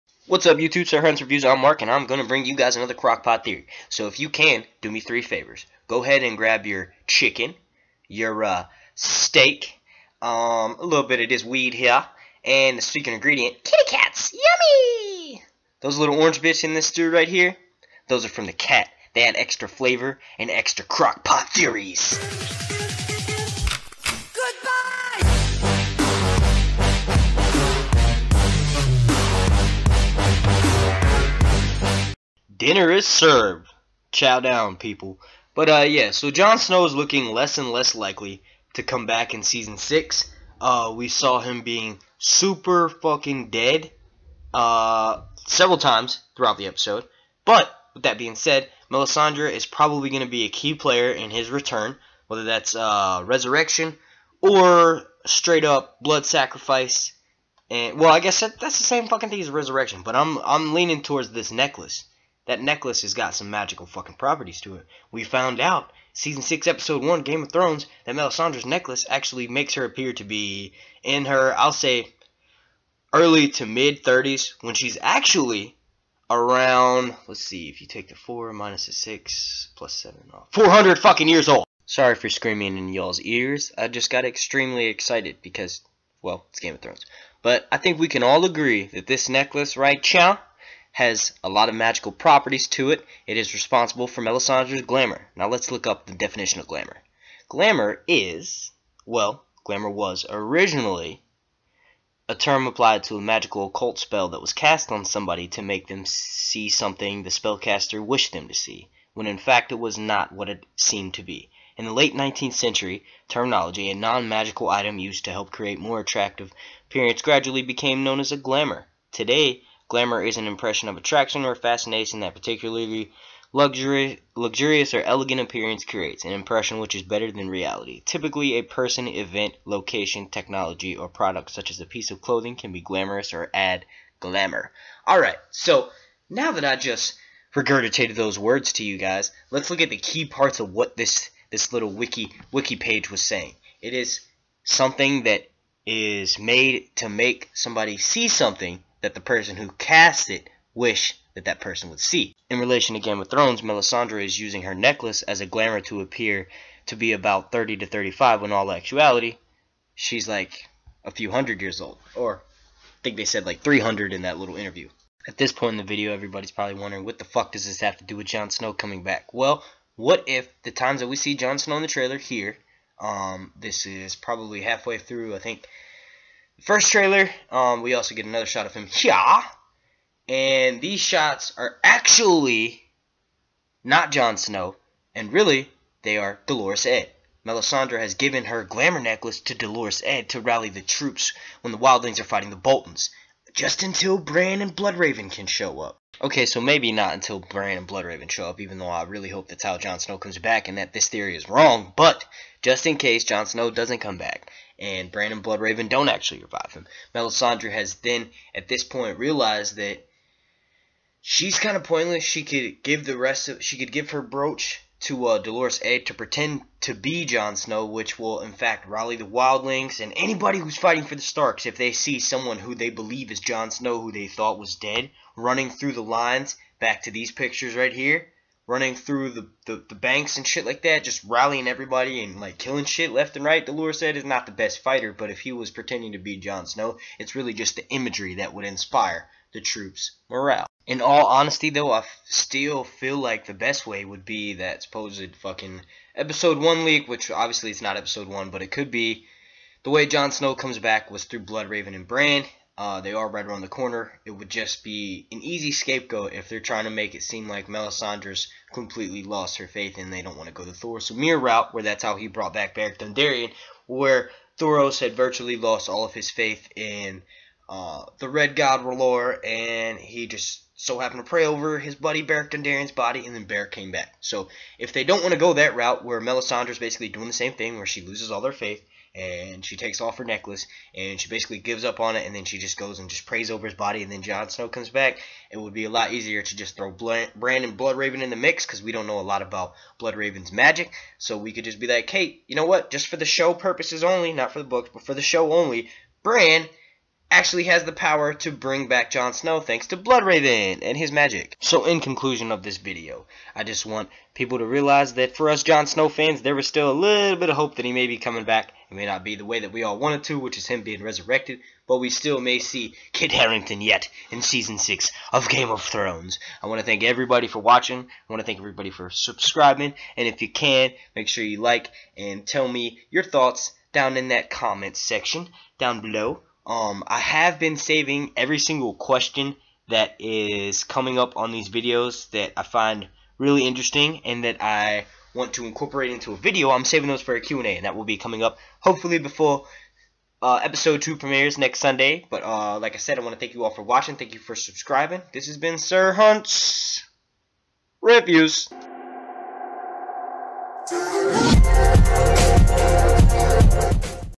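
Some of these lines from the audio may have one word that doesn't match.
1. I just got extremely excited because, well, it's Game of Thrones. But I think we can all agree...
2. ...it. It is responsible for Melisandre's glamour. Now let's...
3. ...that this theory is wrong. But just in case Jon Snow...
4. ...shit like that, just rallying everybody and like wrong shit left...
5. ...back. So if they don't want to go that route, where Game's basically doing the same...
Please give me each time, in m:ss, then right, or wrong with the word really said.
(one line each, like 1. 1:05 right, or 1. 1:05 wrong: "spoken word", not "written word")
1. 1:23 right
2. 1:32 right
3. 3:20 right
4. 3:50 wrong: "killing", not "wrong"
5. 4:33 wrong: "Melisandre", not "Game".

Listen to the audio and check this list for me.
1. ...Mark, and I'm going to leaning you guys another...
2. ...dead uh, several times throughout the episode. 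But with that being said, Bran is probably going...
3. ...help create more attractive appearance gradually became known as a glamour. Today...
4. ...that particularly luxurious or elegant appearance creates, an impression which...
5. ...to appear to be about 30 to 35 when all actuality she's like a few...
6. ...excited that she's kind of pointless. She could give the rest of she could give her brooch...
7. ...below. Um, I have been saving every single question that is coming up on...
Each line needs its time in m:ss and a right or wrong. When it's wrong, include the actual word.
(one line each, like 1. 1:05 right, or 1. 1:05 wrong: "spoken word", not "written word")
1. 0:01 wrong: "bring", not "leaning"
2. 0:43 wrong: "Melisandre", not "Bran"
3. 1:55 right
4. 2:02 right
5. 2:35 right
6. 3:29 wrong: "realized", not "excited"
7. 5:26 right.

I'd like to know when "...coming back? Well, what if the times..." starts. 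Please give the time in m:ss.
2:48.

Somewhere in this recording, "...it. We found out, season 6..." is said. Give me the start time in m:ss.
1:04.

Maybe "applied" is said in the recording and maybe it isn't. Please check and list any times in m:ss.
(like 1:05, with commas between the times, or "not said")
1:42.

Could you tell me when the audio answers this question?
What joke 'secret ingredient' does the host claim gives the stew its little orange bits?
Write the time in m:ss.
0:13.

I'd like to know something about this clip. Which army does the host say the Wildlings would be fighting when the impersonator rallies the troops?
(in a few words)
the Boltons.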